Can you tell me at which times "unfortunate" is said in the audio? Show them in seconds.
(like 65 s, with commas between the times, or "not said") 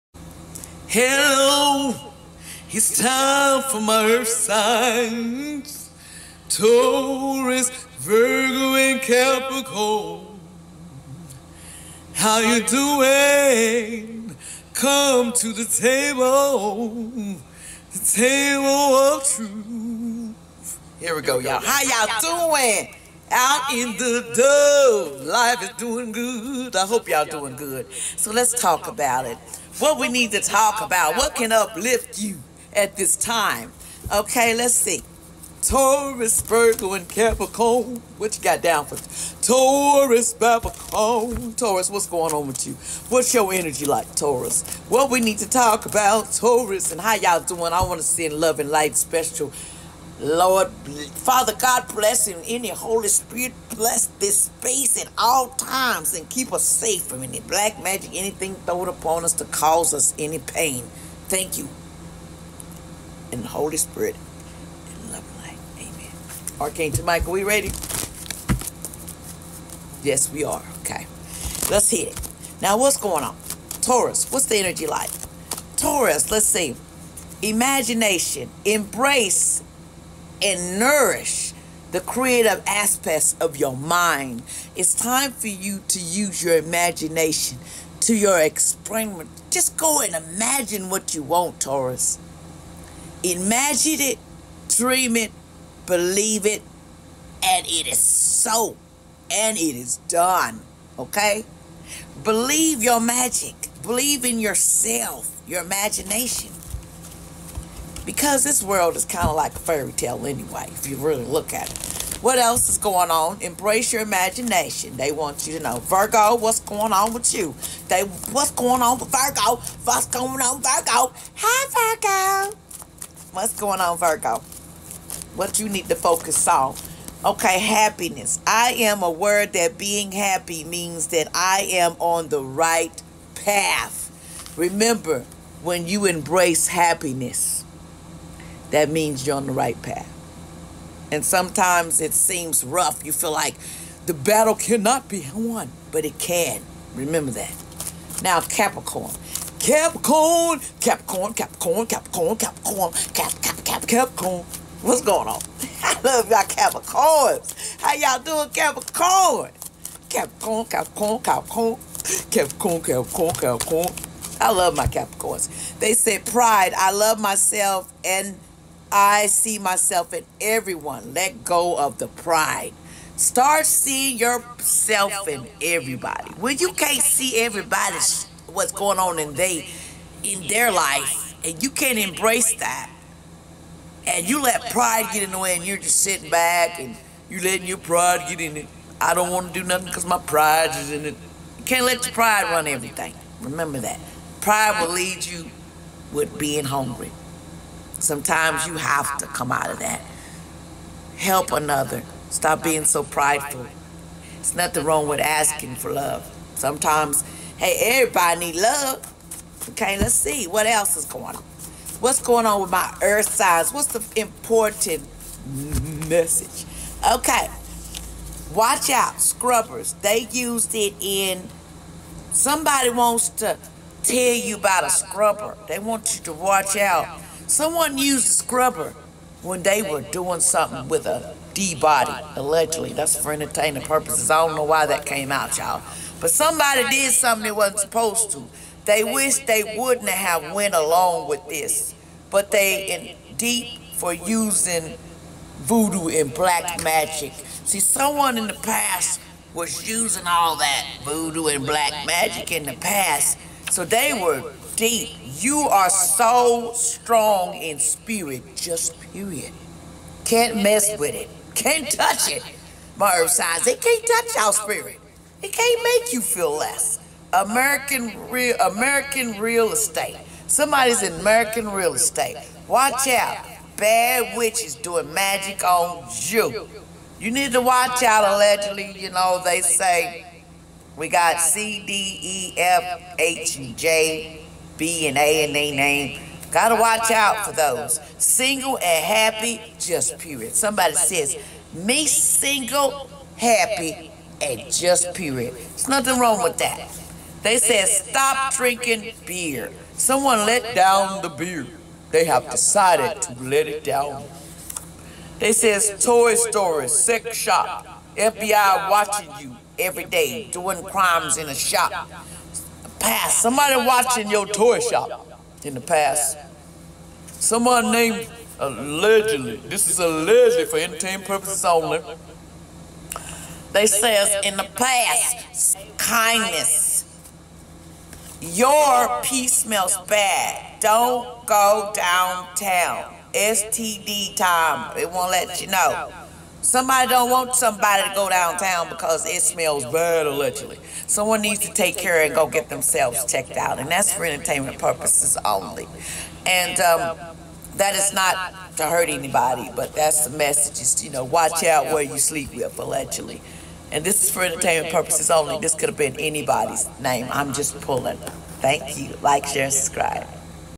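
not said.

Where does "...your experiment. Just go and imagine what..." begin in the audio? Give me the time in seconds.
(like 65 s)
88 s.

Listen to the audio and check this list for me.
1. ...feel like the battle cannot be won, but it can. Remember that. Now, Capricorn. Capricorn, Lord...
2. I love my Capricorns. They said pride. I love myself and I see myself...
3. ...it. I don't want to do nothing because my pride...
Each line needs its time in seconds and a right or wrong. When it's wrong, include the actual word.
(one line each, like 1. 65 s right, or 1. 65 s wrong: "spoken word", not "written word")
1. 143 s wrong: "Capricorn", not "Lord"
2. 164 s right
3. 188 s right.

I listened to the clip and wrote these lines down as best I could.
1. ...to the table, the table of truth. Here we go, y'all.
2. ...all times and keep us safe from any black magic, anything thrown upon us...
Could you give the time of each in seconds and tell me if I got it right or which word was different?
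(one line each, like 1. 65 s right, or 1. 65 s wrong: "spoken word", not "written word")
1. 15 s right
2. 55 s right.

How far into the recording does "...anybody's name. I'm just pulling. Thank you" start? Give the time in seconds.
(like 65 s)
356 s.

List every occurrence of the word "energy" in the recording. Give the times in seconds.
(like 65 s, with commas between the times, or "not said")
43 s, 74 s.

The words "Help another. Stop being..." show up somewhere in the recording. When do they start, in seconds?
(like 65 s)
201 s.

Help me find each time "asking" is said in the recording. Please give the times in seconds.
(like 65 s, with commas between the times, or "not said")
205 s.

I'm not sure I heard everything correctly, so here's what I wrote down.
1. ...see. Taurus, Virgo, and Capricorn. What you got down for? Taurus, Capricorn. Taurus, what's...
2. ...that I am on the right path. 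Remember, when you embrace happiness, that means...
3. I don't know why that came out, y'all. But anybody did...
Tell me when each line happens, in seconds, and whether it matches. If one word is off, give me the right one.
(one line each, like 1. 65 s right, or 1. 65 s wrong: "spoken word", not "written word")
1. 34 s right
2. 131 s right
3. 234 s wrong: "somebody", not "anybody".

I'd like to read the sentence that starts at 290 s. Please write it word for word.
Somebody says, me single, happy, and just period.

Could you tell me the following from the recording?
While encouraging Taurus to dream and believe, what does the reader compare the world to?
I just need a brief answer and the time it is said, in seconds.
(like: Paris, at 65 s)
a fairy tale, at 109 s.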